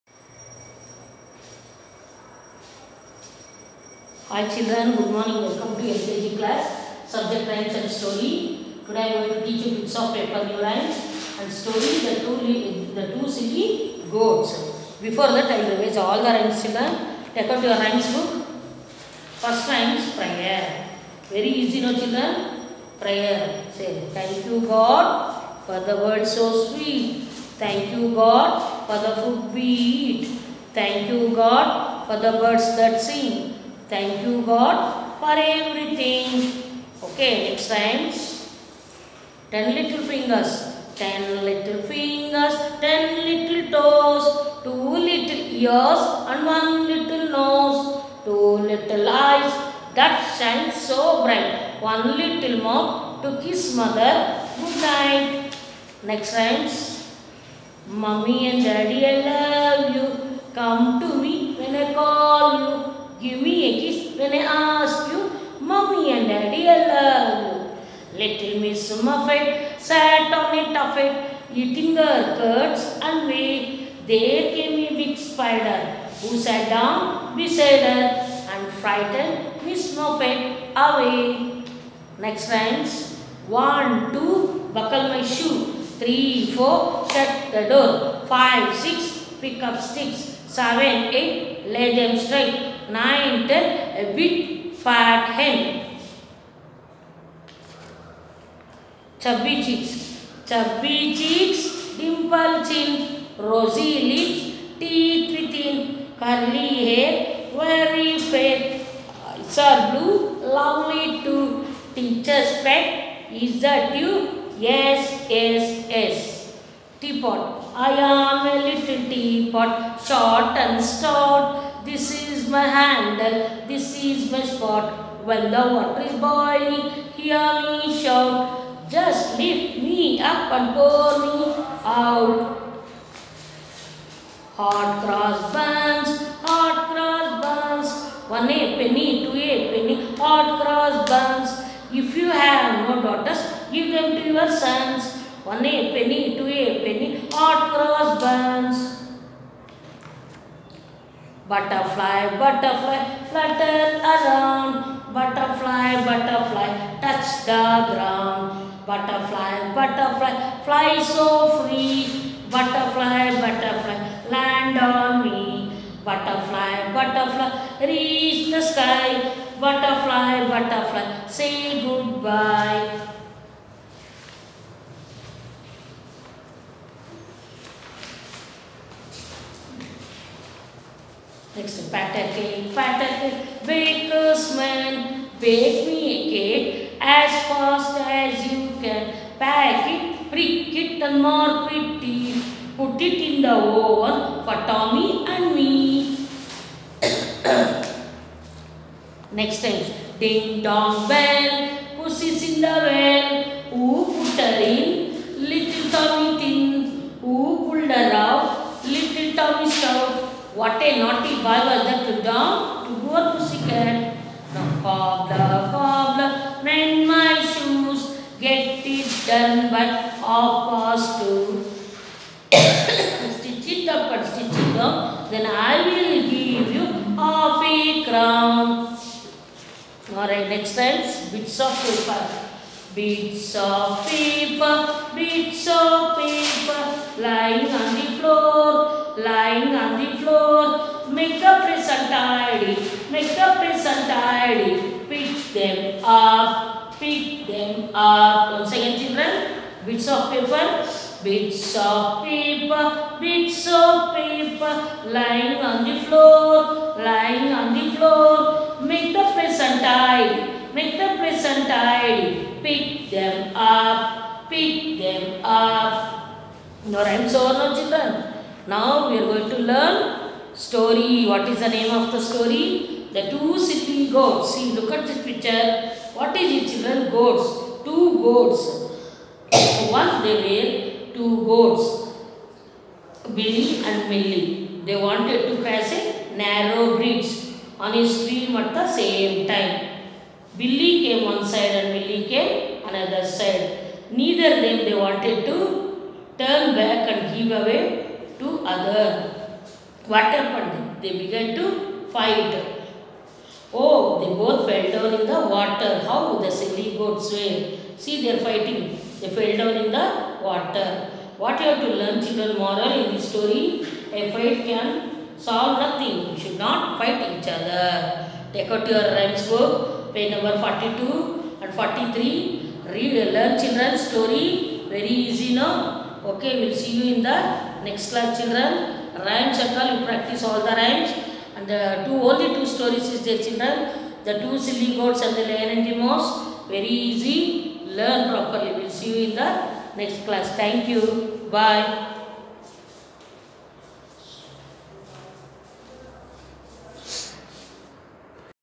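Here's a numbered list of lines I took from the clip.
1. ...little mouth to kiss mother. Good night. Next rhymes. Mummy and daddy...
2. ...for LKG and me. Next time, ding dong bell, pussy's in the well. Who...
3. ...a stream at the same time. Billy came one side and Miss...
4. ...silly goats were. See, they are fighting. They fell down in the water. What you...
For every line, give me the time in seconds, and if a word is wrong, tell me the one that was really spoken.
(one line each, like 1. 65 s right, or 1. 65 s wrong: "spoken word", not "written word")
1. 52 s right
2. 194 s wrong: "Tommy", not "LKG"
3. 287 s wrong: "Millie", not "Miss"
4. 306 s right.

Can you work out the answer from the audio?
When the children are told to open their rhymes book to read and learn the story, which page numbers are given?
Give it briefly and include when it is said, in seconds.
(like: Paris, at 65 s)
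42 and 43, at 320 s.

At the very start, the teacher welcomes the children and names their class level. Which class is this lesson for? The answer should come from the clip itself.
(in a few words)
LKG.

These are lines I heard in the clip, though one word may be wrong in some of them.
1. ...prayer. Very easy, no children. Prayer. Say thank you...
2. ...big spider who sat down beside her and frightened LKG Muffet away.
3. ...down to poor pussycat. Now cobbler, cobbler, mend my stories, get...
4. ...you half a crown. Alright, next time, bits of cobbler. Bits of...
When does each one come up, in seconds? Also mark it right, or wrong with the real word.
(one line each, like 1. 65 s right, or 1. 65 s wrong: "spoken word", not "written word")
1. 20 s right
2. 74 s wrong: "Miss", not "LKG"
3. 212 s wrong: "shoes", not "stories"
4. 226 s wrong: "paper", not "cobbler".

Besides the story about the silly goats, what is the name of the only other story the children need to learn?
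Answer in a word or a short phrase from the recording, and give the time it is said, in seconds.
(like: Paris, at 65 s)
The Lion and the Mouse, at 335 s.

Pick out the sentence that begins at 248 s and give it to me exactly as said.
Once again children, bits of paper, bits of paper, bits of paper, lying on the floor, lying on the floor.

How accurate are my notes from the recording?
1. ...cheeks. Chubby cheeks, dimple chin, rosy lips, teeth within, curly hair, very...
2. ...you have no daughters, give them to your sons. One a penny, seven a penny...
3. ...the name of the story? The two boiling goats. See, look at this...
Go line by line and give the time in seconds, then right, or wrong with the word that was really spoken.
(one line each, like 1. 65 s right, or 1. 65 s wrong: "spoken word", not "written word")
1. 99 s right
2. 142 s wrong: "two", not "seven"
3. 271 s wrong: "sitting", not "boiling".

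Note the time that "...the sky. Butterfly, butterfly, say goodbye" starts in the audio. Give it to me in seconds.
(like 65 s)
168 s.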